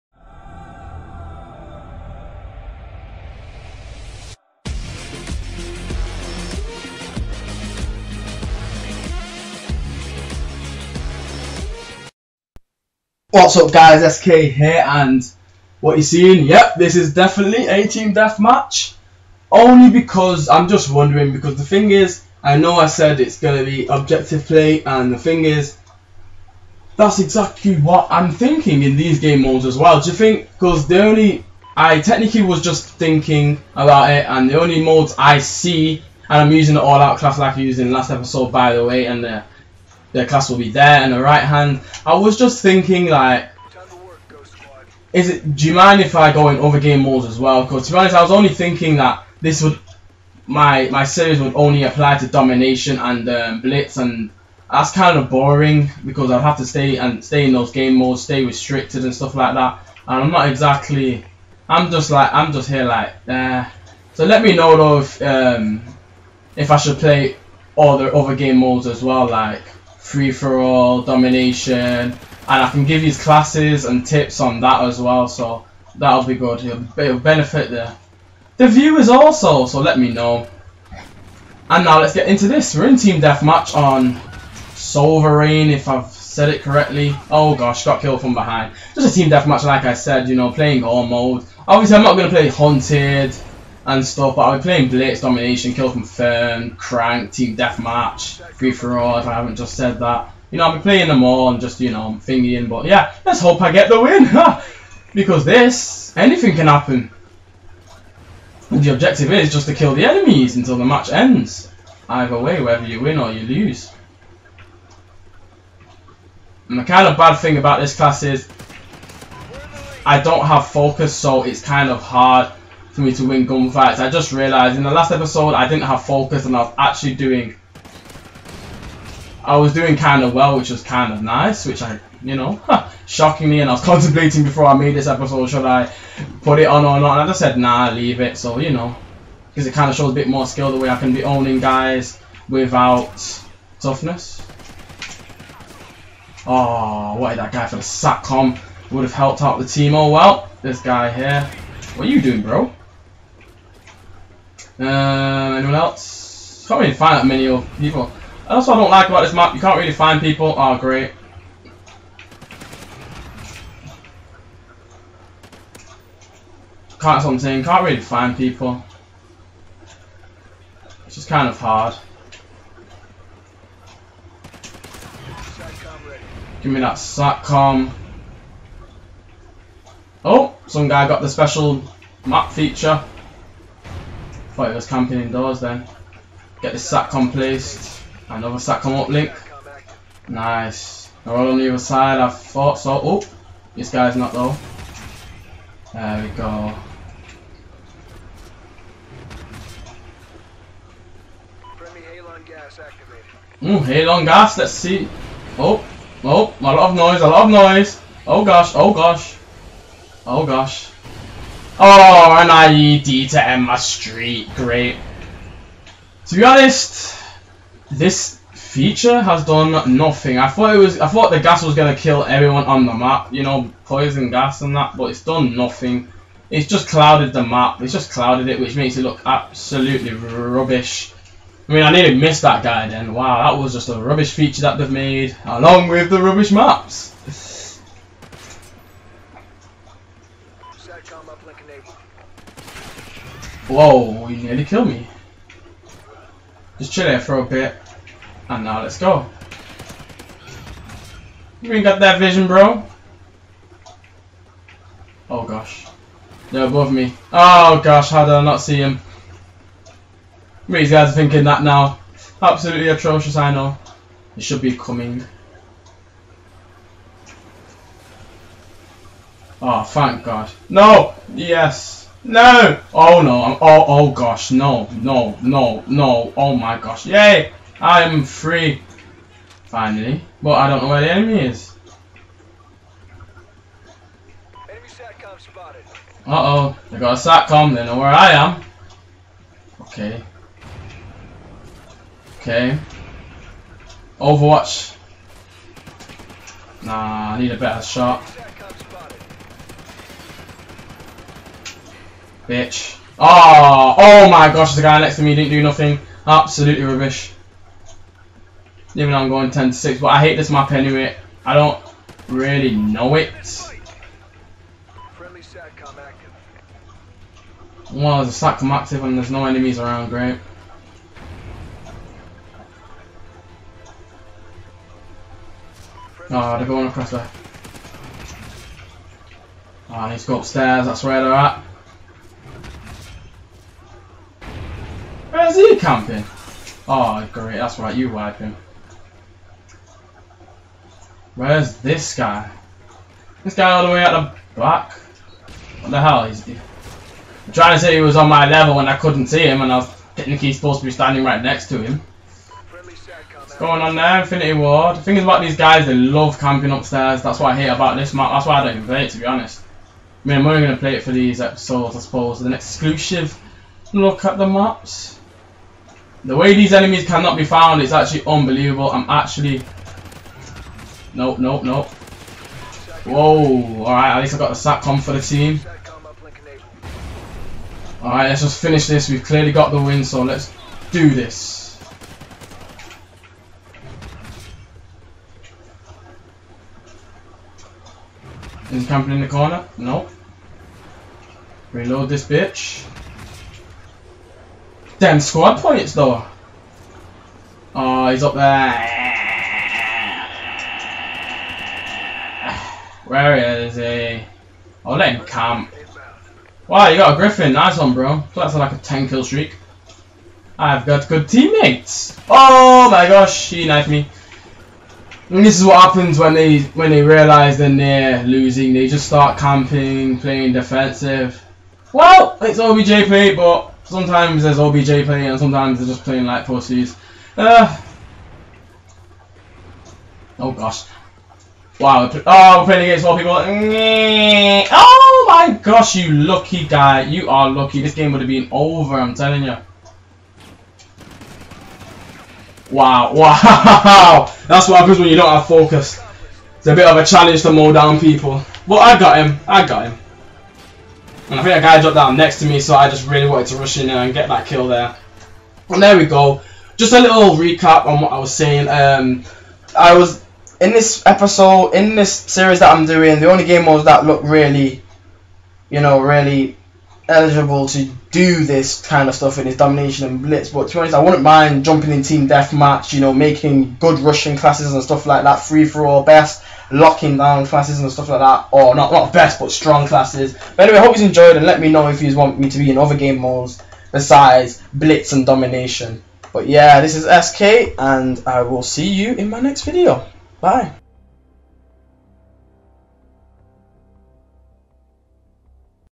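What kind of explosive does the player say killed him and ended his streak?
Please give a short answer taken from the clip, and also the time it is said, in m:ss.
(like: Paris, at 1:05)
IED, at 3:32.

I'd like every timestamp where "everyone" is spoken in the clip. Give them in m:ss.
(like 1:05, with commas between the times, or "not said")
3:42.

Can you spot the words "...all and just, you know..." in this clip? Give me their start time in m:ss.
1:41.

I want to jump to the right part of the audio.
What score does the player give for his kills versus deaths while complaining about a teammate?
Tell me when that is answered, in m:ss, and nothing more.
5:09.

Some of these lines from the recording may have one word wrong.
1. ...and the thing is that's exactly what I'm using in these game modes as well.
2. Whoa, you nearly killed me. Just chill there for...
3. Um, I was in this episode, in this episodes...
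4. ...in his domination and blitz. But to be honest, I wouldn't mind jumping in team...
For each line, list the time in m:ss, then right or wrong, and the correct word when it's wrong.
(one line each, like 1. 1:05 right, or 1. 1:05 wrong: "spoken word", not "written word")
1. 0:24 wrong: "thinking", not "using"
2. 4:03 right
3. 7:38 wrong: "series", not "episodes"
4. 7:49 right.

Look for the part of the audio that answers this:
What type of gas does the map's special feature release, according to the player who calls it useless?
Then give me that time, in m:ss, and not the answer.
3:23.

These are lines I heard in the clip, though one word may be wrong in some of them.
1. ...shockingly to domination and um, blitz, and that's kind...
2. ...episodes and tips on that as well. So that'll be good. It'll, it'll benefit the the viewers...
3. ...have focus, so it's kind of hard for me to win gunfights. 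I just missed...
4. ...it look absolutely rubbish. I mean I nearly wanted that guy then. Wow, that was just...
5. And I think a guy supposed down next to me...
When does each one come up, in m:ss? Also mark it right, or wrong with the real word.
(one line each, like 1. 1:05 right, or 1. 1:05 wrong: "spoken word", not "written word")
1. 0:51 wrong: "apply", not "shockingly"
2. 1:13 wrong: "classes", not "episodes"
3. 2:00 wrong: "realised", not "missed"
4. 3:48 wrong: "missed", not "wanted"
5. 7:31 wrong: "dropped", not "supposed".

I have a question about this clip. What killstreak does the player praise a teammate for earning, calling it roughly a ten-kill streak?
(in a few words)
Gryphon.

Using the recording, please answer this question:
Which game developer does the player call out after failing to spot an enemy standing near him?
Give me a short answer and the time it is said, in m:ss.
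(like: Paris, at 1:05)
Infinity Ward, at 5:54.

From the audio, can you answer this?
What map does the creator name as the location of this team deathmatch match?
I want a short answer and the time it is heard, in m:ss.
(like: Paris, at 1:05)
Sovereign, at 1:24.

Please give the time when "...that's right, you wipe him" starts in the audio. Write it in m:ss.
5:37.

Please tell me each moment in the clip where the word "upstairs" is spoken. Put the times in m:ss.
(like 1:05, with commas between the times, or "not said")
5:30, 5:56.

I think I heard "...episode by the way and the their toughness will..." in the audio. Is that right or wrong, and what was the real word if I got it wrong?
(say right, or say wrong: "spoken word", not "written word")
wrong: "class", not "toughness".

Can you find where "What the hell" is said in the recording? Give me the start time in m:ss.
5:45.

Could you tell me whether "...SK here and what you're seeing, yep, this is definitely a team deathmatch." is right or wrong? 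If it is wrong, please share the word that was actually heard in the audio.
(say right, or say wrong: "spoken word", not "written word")
right.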